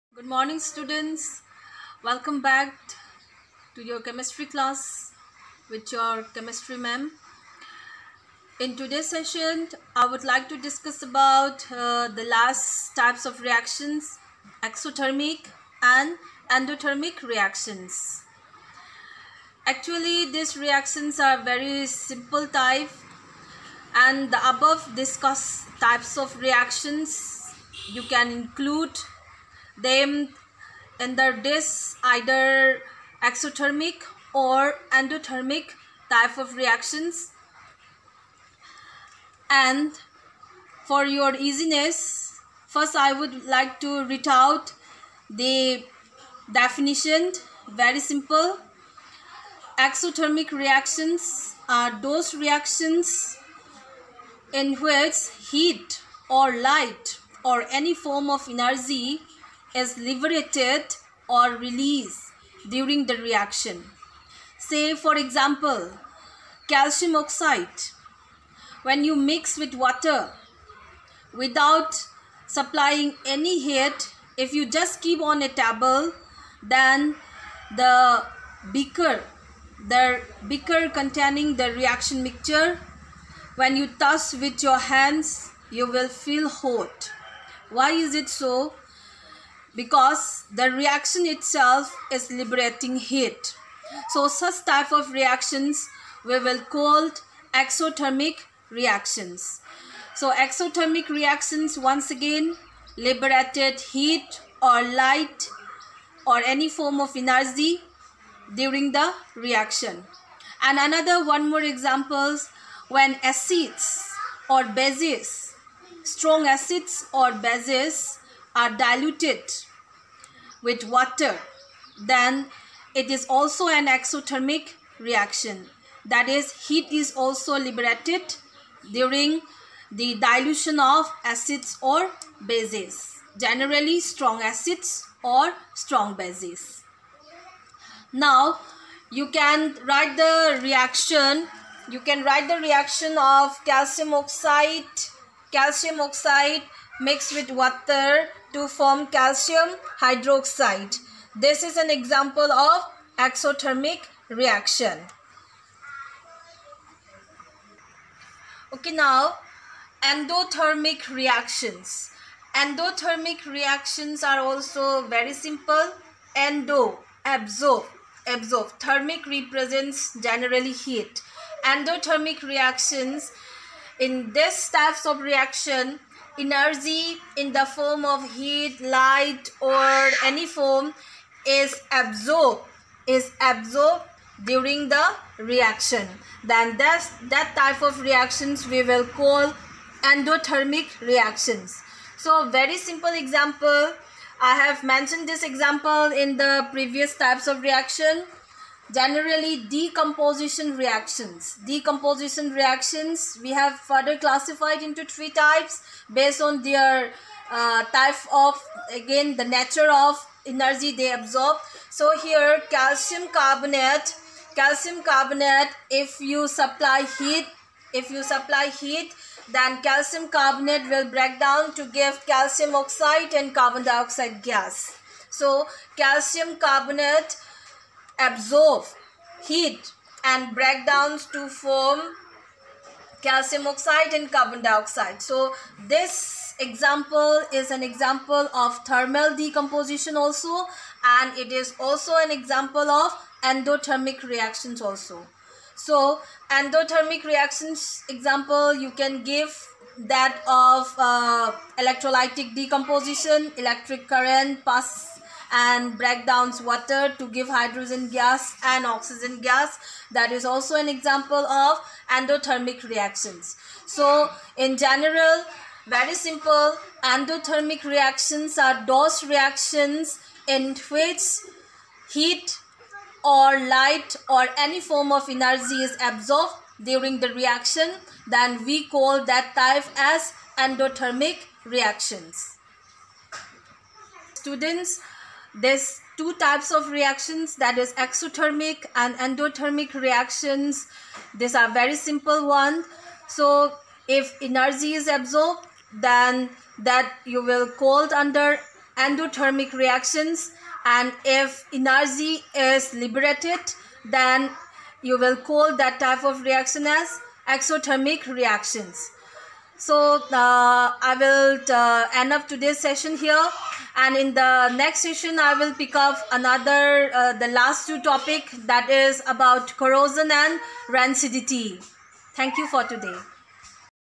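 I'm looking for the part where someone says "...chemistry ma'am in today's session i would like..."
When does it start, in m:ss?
0:06.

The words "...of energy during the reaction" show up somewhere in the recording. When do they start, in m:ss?
1:46.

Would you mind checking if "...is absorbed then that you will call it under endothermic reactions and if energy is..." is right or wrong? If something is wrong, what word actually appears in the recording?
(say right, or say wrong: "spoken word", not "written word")
right.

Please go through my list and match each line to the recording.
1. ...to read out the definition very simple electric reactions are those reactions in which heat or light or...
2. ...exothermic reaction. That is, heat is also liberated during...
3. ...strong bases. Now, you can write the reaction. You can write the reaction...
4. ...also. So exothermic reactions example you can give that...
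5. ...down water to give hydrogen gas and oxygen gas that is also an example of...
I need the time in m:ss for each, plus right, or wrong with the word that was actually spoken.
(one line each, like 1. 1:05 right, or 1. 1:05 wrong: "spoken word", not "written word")
1. 0:43 wrong: "exothermic", not "electric"
2. 2:03 right
3. 2:15 right
4. 4:04 wrong: "endothermic", not "exothermic"
5. 4:16 right.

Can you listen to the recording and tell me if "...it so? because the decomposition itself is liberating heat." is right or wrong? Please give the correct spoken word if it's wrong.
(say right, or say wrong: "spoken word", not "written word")
wrong: "reaction", not "decomposition".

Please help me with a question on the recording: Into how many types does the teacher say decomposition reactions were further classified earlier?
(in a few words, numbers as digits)
3.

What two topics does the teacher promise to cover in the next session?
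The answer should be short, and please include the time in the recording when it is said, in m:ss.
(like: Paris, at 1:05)
Corrosion and rancidity, at 5:19.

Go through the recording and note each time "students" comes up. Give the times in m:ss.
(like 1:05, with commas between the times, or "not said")
0:00, 4:44.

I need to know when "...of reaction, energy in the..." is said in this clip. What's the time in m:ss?
2:55.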